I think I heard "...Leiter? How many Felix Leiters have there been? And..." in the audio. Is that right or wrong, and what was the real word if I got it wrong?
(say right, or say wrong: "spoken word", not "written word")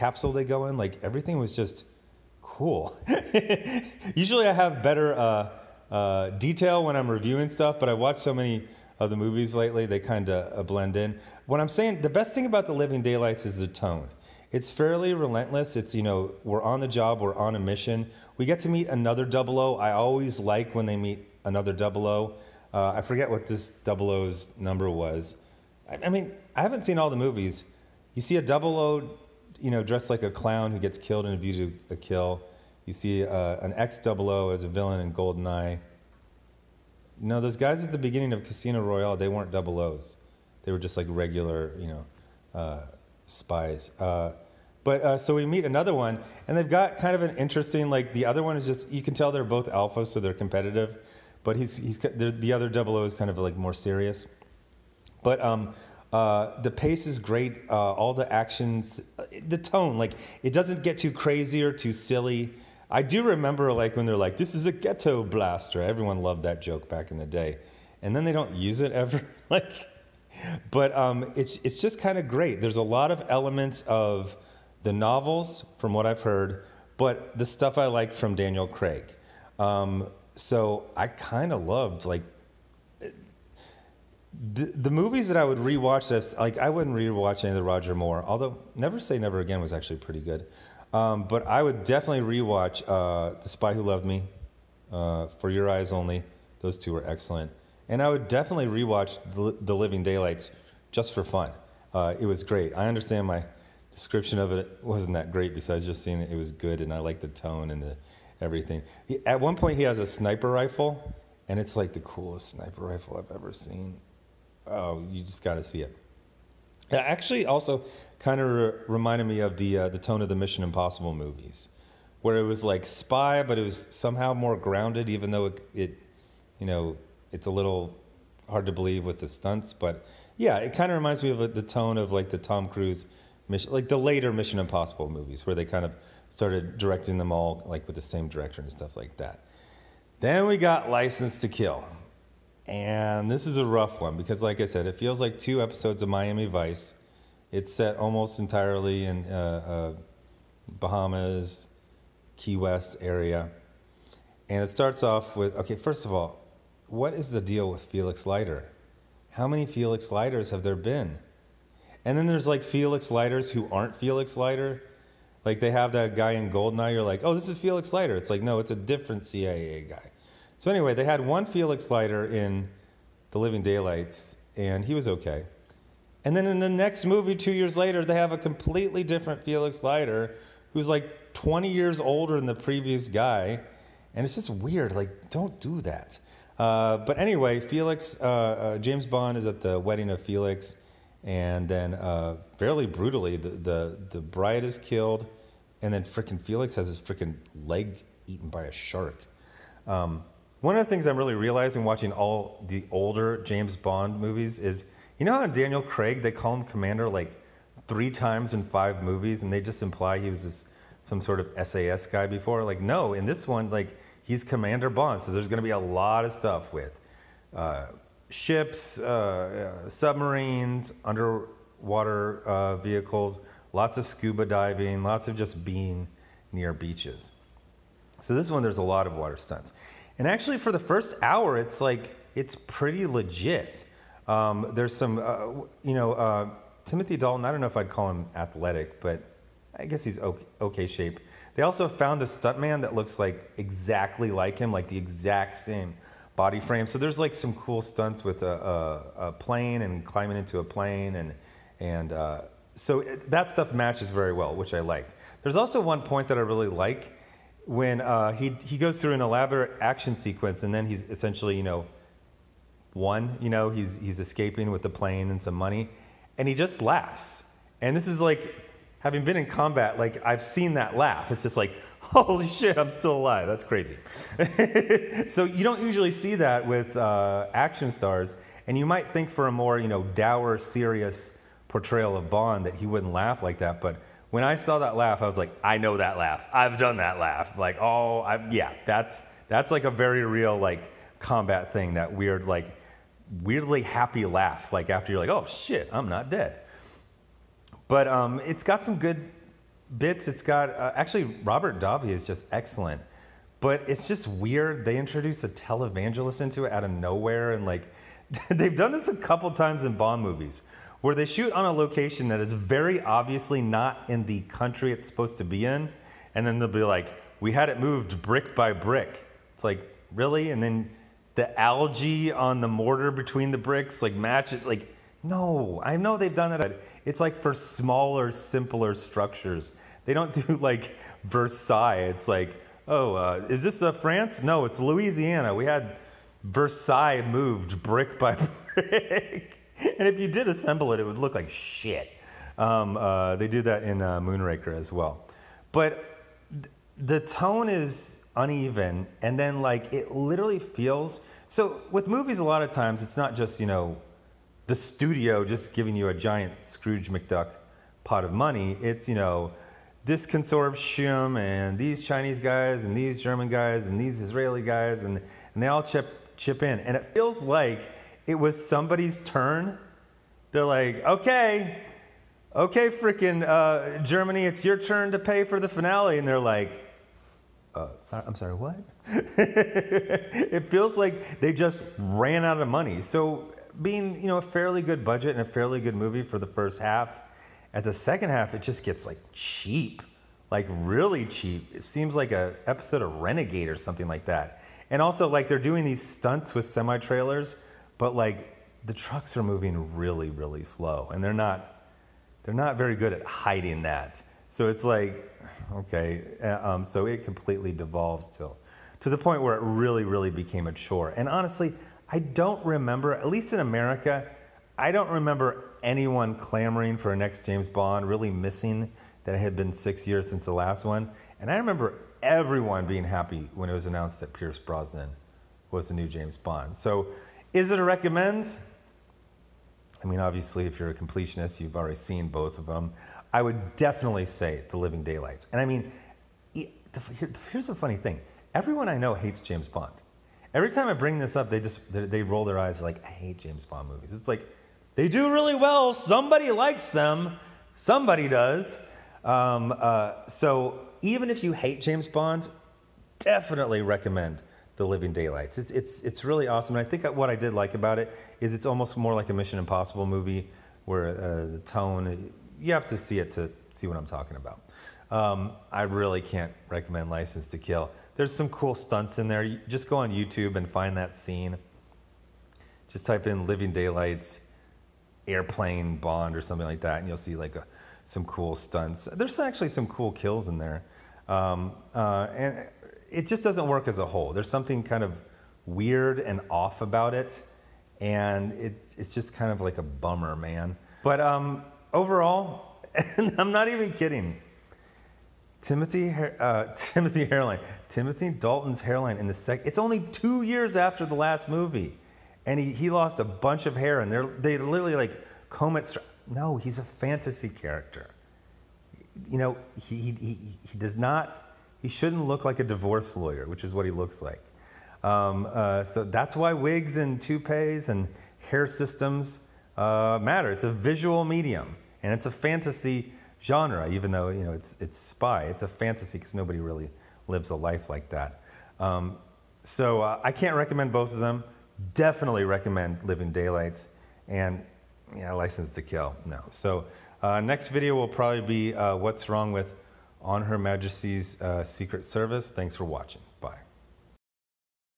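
right.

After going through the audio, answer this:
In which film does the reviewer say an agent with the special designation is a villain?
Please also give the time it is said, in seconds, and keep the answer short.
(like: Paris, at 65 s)
GoldenEye, at 35 s.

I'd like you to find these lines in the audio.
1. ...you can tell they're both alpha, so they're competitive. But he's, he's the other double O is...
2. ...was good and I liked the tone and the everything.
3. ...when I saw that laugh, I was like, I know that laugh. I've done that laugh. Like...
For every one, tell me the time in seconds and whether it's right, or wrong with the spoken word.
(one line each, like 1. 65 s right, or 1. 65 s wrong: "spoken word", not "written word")
1. 48 s right
2. 106 s right
3. 284 s right.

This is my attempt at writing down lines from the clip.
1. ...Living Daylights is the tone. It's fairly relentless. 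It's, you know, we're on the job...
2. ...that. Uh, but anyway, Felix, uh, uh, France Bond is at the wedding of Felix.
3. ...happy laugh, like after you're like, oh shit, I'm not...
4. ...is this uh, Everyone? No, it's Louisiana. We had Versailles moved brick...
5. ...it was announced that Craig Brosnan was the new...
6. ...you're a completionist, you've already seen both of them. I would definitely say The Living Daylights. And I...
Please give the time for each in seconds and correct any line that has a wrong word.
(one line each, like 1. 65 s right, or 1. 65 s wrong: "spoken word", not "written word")
1. 12 s right
2. 185 s wrong: "James", not "France"
3. 293 s right
4. 333 s wrong: "France", not "Everyone"
5. 423 s wrong: "Pierce", not "Craig"
6. 430 s right.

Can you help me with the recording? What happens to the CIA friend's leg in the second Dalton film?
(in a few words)
eaten by a shark.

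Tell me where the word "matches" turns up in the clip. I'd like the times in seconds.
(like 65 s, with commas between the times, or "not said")
253 s, 324 s.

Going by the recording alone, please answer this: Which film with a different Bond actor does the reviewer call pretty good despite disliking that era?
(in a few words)
Never Say Never Again.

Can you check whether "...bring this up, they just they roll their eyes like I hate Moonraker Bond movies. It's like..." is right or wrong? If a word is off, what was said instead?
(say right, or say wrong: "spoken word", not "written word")
wrong: "James", not "Moonraker".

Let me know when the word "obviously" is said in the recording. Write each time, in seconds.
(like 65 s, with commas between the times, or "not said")
313 s, 430 s.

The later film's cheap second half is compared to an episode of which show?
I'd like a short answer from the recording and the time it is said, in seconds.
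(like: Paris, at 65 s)
Renegade, at 393 s.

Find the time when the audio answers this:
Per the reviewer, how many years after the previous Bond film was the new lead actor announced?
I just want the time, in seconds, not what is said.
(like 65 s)
419 s.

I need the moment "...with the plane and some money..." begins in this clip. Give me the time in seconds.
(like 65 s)
264 s.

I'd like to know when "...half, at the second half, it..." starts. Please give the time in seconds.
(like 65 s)
386 s.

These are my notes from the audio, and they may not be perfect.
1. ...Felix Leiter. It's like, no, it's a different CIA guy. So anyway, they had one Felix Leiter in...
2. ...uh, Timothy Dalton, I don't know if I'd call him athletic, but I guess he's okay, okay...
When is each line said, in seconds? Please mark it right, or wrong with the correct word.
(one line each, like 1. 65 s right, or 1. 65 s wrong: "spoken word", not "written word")
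1. 167 s right
2. 236 s right.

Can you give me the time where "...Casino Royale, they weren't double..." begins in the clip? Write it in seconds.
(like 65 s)
38 s.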